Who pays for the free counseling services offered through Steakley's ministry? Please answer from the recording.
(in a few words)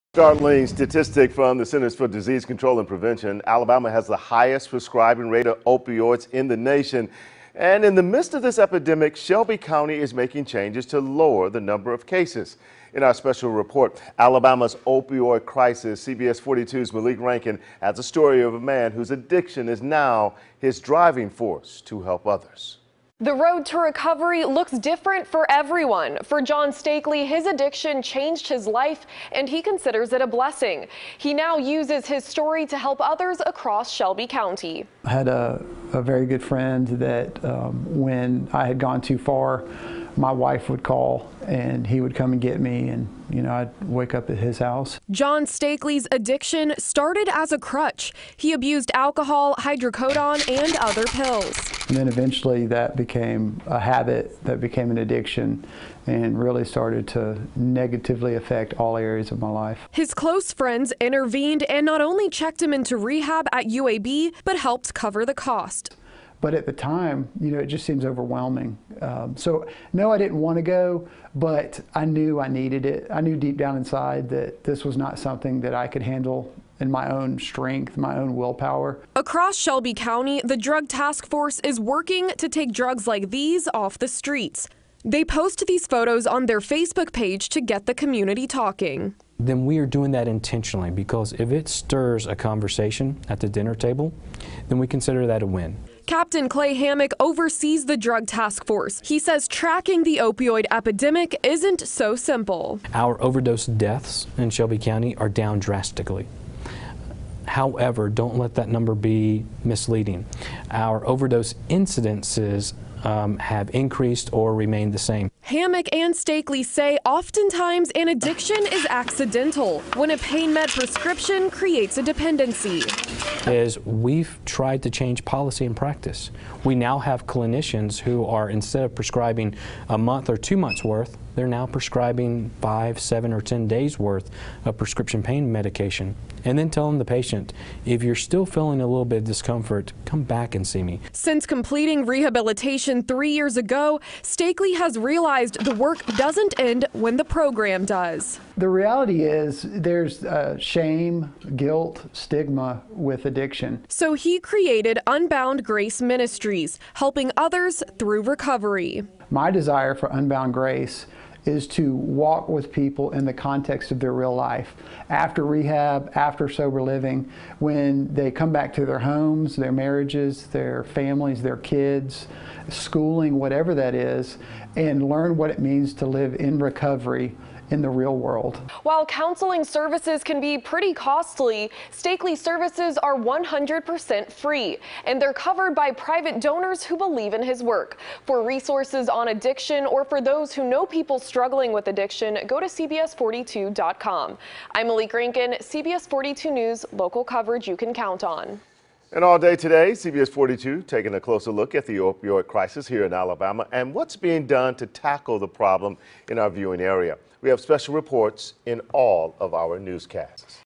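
private donors.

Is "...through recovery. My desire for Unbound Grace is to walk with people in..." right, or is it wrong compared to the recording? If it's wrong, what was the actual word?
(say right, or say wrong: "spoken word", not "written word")
right.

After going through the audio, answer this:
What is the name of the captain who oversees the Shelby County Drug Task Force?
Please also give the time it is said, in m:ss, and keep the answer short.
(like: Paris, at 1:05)
Clay Hammac, at 1:36.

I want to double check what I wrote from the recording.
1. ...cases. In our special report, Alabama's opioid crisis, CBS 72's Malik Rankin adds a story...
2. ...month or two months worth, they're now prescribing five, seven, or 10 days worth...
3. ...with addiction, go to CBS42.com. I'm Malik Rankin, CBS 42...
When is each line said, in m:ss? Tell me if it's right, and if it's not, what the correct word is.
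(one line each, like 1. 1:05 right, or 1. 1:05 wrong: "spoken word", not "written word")
1. 0:12 wrong: "42", not "72"
2. 2:09 right
3. 3:11 right.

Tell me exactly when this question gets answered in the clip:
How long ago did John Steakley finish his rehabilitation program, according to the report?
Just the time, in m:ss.
2:23.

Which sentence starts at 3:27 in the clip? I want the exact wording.
We have special reports in all of our newscasts.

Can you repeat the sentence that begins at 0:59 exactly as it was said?
His close friends intervened and not only checked him into rehab at UAB, but helped cover the cost.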